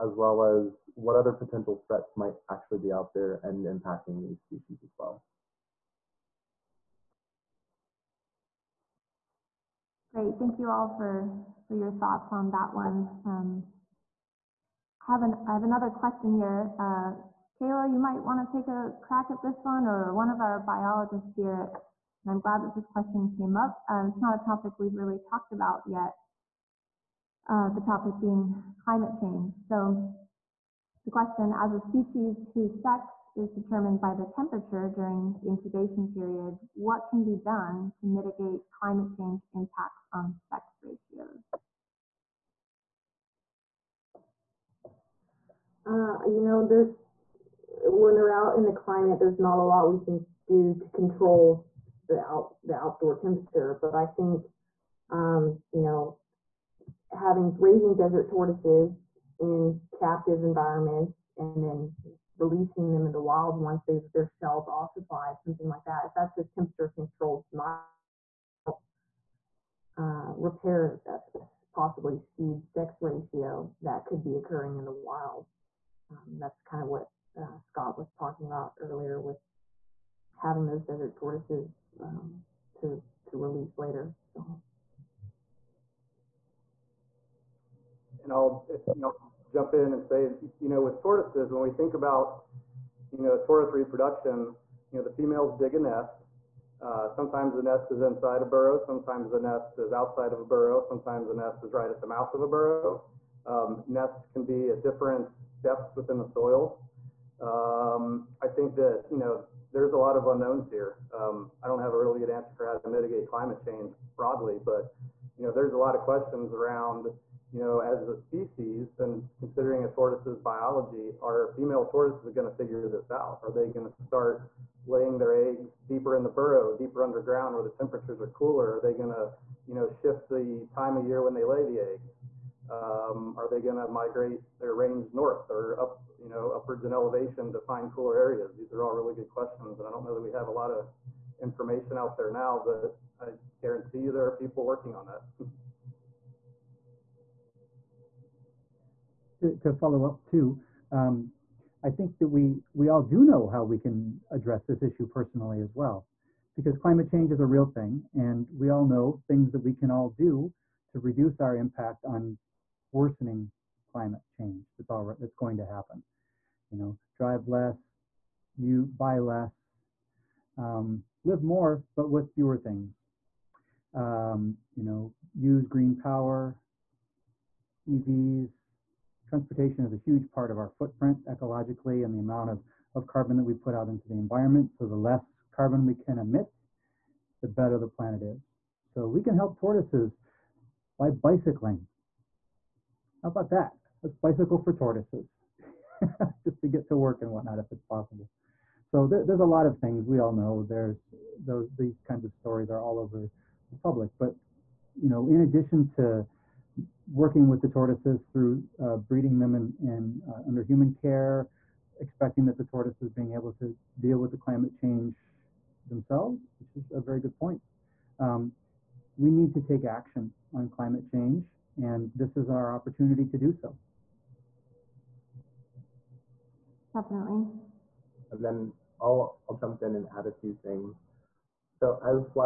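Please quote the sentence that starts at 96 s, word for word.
Uh, sometimes the nest is inside a burrow.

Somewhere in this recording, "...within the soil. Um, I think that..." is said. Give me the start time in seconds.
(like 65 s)
105 s.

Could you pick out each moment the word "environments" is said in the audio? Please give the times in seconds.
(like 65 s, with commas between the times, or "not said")
60 s, 184 s.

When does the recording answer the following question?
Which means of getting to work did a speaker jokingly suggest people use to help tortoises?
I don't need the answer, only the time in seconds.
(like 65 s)
191 s.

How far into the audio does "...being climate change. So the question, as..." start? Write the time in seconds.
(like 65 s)
28 s.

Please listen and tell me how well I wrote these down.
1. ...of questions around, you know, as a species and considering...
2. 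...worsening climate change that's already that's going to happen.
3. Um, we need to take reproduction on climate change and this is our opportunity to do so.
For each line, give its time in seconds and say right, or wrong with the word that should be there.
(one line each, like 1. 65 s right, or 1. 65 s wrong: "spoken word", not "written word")
1. 115 s right
2. 162 s right
3. 218 s wrong: "action", not "reproduction".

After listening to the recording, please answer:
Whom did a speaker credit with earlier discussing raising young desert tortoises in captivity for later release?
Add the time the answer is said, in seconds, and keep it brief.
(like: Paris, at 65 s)
Scott, at 77 s.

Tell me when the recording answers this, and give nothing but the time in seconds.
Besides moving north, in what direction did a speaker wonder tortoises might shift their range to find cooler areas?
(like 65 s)
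136 s.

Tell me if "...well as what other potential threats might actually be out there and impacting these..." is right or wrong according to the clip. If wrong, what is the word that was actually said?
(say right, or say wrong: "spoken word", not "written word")
right.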